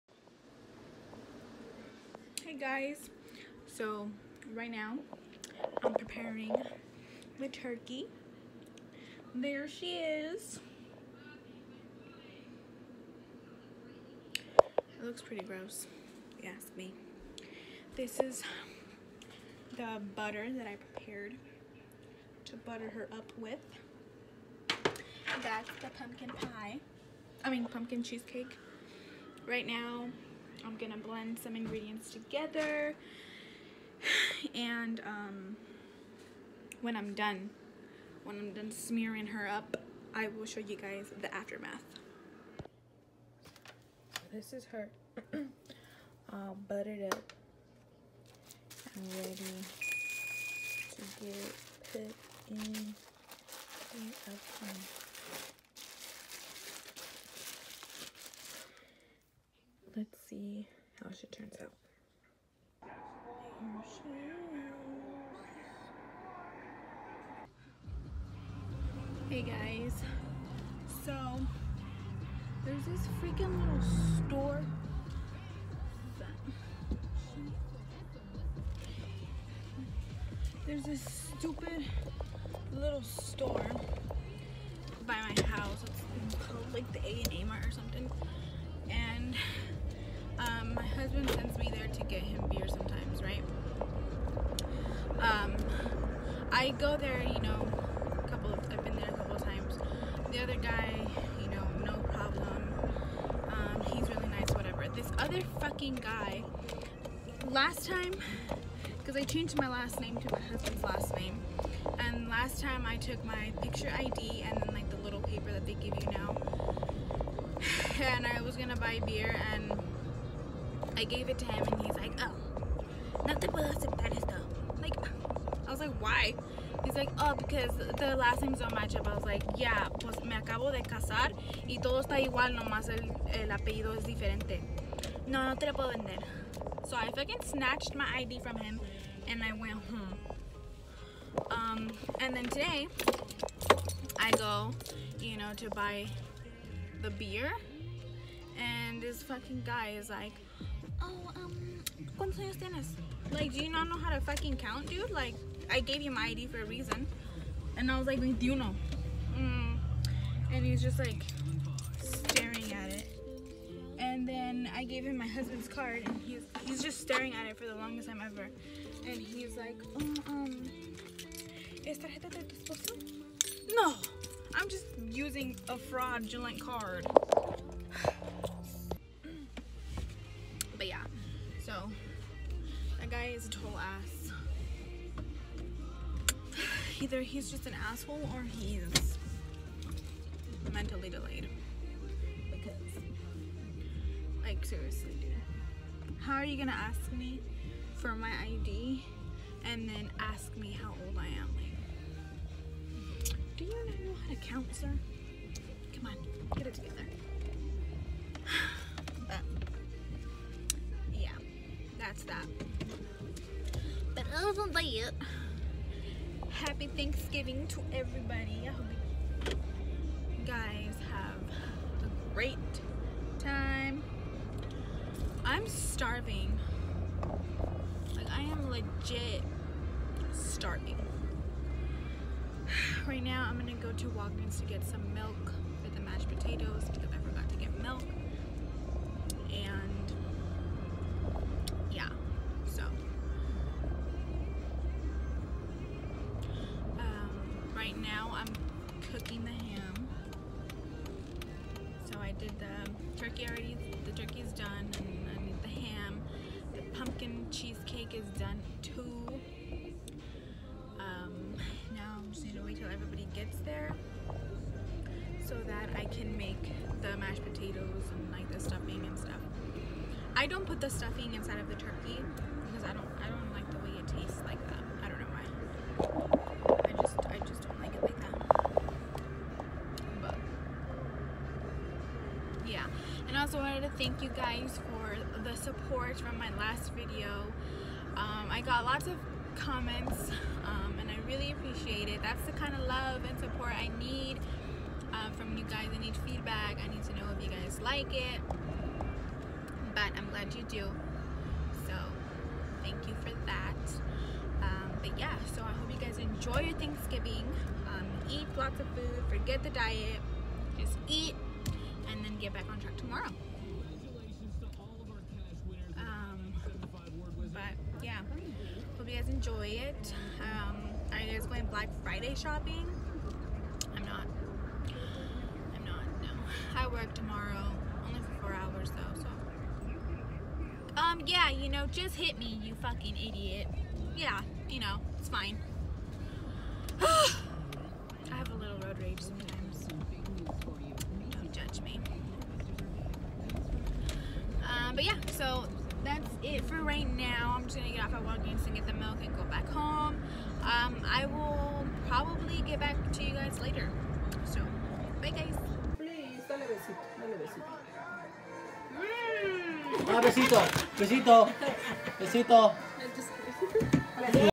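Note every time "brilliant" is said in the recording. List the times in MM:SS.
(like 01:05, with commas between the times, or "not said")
not said.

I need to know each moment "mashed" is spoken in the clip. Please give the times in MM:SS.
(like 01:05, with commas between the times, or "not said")
03:56, 04:27.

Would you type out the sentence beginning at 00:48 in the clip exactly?
and ready to get put in the oven.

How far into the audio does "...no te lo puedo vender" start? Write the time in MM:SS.
02:15.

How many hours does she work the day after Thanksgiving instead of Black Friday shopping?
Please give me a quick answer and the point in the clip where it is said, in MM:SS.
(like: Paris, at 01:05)
4, at 05:28.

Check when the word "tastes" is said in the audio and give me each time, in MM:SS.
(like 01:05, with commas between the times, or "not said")
04:34.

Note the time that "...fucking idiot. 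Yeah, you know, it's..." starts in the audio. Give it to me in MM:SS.
05:32.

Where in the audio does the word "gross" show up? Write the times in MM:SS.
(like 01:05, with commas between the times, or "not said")
00:15.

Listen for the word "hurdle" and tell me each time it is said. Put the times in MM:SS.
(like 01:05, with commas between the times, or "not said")
not said.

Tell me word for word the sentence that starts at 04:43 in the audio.
And I also wanted to thank you guys for the support from my last video.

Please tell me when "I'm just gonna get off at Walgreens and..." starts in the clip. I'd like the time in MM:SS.
05:47.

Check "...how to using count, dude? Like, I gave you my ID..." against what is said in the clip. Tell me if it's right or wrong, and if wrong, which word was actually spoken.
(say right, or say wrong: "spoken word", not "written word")
wrong: "fucking", not "using".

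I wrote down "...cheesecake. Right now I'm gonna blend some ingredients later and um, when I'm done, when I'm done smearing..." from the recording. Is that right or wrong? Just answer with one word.
wrong.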